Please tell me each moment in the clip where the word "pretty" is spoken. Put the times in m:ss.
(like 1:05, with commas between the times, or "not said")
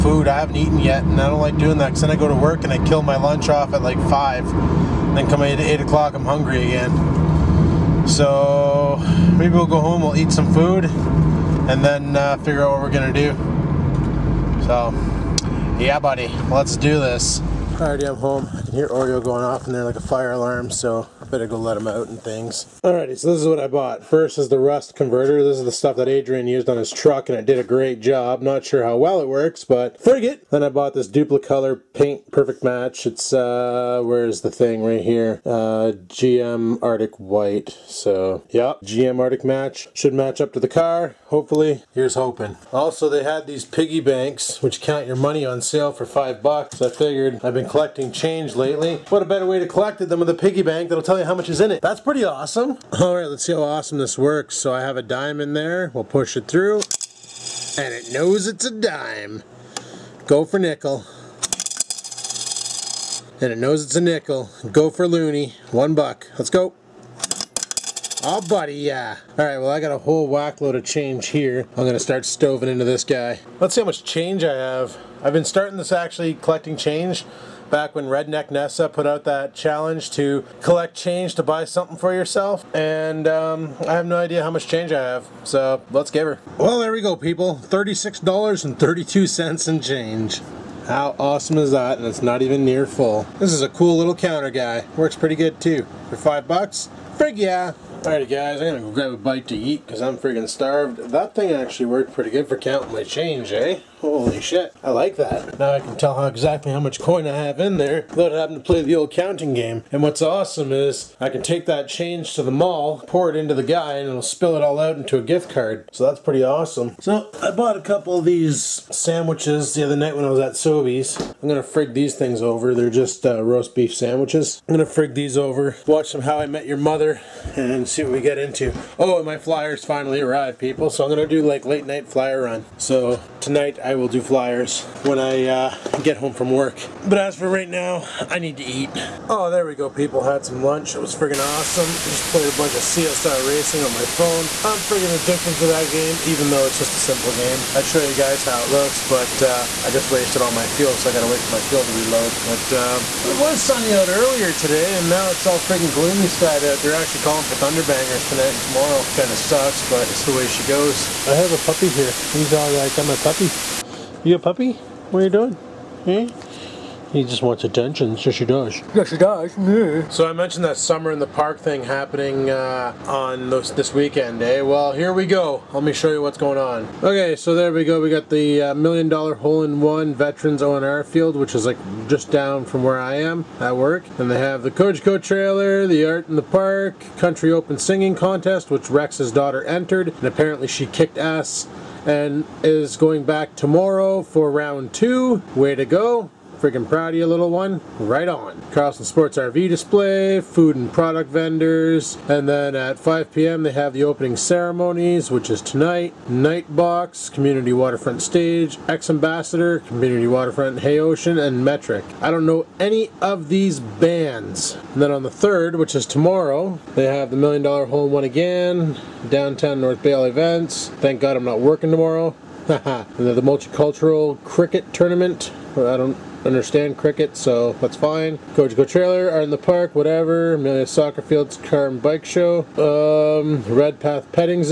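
0:51, 1:35, 1:42, 1:56.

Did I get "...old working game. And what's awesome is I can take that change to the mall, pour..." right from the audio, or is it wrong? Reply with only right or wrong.
wrong.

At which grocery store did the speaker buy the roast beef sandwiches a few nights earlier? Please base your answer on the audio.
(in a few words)
Sobeys.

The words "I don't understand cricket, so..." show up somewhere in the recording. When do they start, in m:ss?
3:45.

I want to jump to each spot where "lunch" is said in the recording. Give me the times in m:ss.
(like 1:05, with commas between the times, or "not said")
0:03, 2:20.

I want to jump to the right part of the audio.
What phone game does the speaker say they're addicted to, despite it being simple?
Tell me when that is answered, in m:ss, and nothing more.
2:22.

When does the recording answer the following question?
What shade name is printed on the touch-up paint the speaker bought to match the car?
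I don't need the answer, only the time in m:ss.
0:36.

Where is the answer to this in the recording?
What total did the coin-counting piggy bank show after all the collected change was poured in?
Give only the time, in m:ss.
1:27.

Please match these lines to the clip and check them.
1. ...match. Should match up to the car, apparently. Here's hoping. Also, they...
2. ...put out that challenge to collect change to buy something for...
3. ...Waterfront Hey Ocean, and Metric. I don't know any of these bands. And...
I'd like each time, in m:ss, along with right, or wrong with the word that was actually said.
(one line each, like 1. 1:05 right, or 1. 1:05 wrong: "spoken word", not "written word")
1. 0:39 wrong: "hopefully", not "apparently"
2. 1:18 right
3. 3:30 right.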